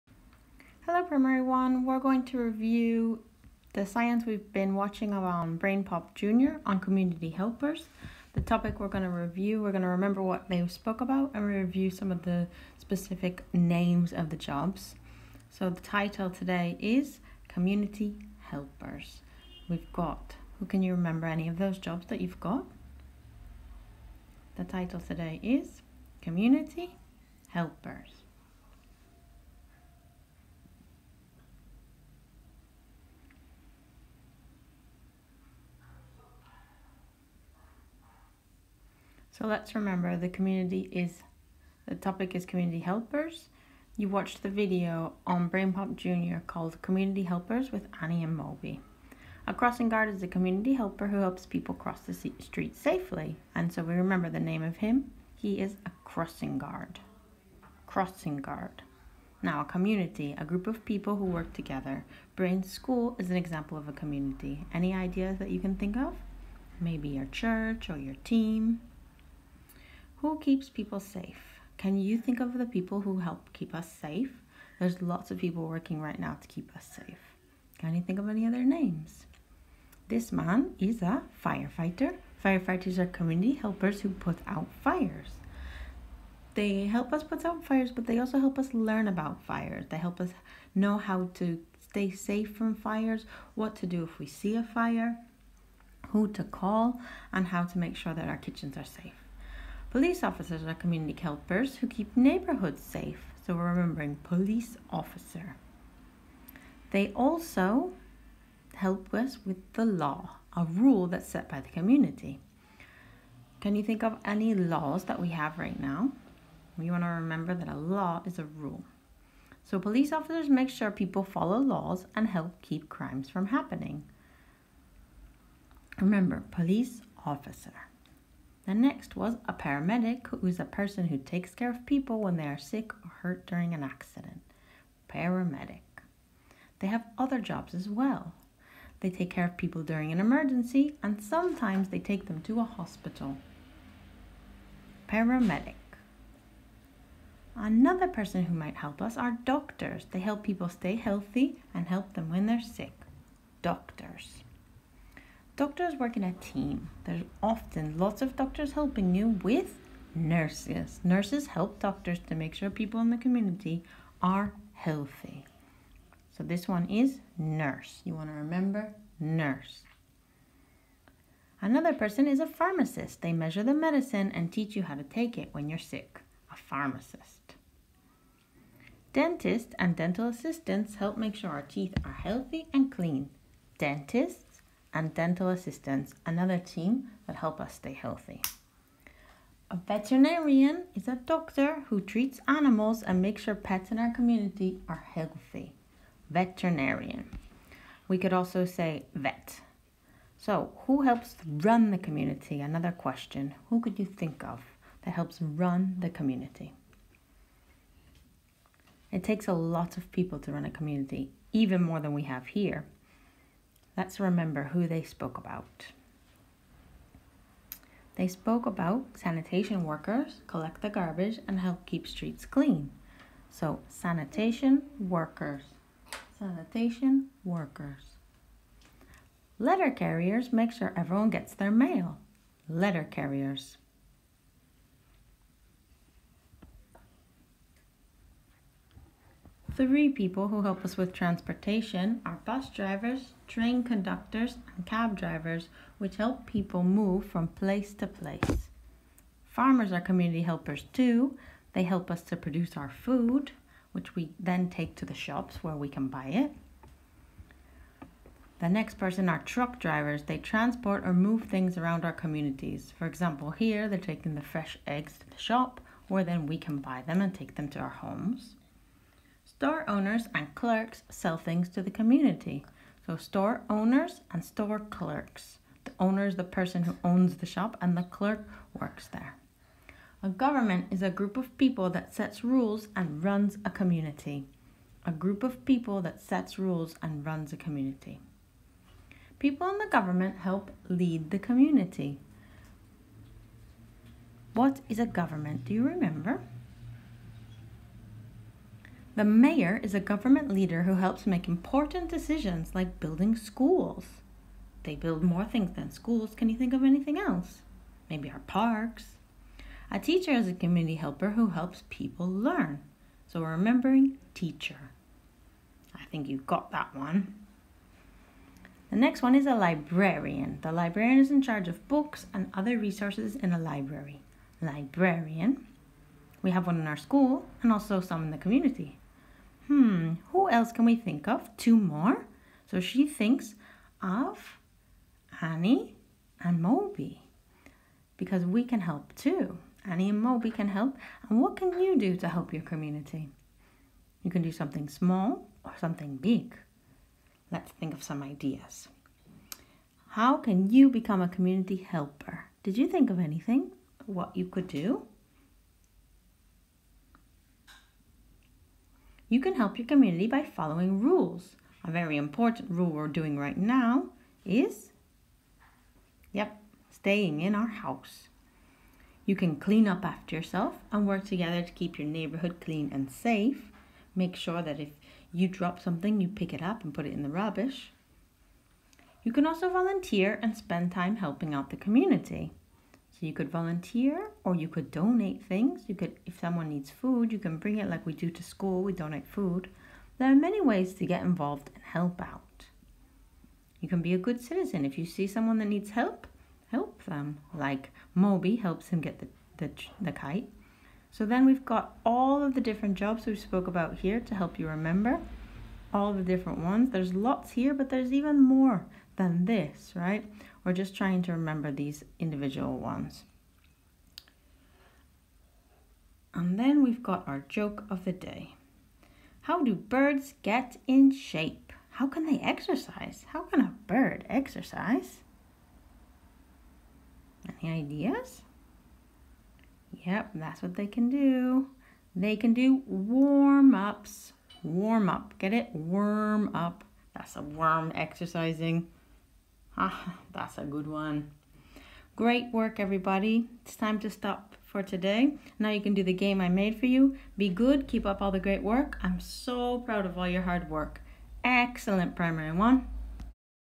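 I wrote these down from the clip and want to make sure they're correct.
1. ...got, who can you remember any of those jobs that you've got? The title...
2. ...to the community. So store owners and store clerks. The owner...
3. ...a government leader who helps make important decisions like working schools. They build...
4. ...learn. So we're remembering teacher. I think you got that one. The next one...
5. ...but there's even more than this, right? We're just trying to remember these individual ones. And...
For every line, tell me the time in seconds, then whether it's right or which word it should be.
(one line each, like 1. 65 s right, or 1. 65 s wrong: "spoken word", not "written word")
1. 19 s right
2. 271 s right
3. 299 s wrong: "building", not "working"
4. 312 s right
5. 407 s right.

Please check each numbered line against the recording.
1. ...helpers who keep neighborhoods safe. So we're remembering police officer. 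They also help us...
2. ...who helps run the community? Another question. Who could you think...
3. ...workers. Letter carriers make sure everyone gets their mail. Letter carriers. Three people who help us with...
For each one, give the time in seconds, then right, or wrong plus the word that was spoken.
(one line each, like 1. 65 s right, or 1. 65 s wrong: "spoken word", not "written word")
1. 101 s right
2. 200 s right
3. 227 s right.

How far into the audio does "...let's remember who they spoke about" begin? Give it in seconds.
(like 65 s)
214 s.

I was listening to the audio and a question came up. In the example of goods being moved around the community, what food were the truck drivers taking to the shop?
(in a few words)
Fresh eggs.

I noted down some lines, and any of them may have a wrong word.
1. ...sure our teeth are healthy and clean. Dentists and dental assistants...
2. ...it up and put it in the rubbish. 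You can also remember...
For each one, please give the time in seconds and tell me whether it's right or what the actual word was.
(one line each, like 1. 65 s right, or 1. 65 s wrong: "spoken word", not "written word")
1. 181 s right
2. 376 s wrong: "volunteer", not "remember".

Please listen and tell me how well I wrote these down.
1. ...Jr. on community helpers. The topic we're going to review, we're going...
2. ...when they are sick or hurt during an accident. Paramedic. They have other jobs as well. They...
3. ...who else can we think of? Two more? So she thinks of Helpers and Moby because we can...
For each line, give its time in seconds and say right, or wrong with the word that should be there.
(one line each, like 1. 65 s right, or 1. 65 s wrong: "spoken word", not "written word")
1. 6 s right
2. 132 s right
3. 330 s wrong: "Annie", not "Helpers".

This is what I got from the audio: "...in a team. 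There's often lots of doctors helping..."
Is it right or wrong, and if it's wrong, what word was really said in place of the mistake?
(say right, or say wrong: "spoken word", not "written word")
right.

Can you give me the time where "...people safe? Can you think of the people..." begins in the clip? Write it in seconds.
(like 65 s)
70 s.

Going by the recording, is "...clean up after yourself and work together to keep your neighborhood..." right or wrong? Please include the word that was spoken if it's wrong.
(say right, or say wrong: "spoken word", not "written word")
right.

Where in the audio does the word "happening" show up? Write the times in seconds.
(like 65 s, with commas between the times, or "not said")
123 s.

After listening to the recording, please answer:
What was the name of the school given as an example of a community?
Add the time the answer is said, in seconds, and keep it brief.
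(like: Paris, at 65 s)
Brains School, at 62 s.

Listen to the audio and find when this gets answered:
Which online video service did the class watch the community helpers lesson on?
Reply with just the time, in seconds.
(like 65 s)
45 s.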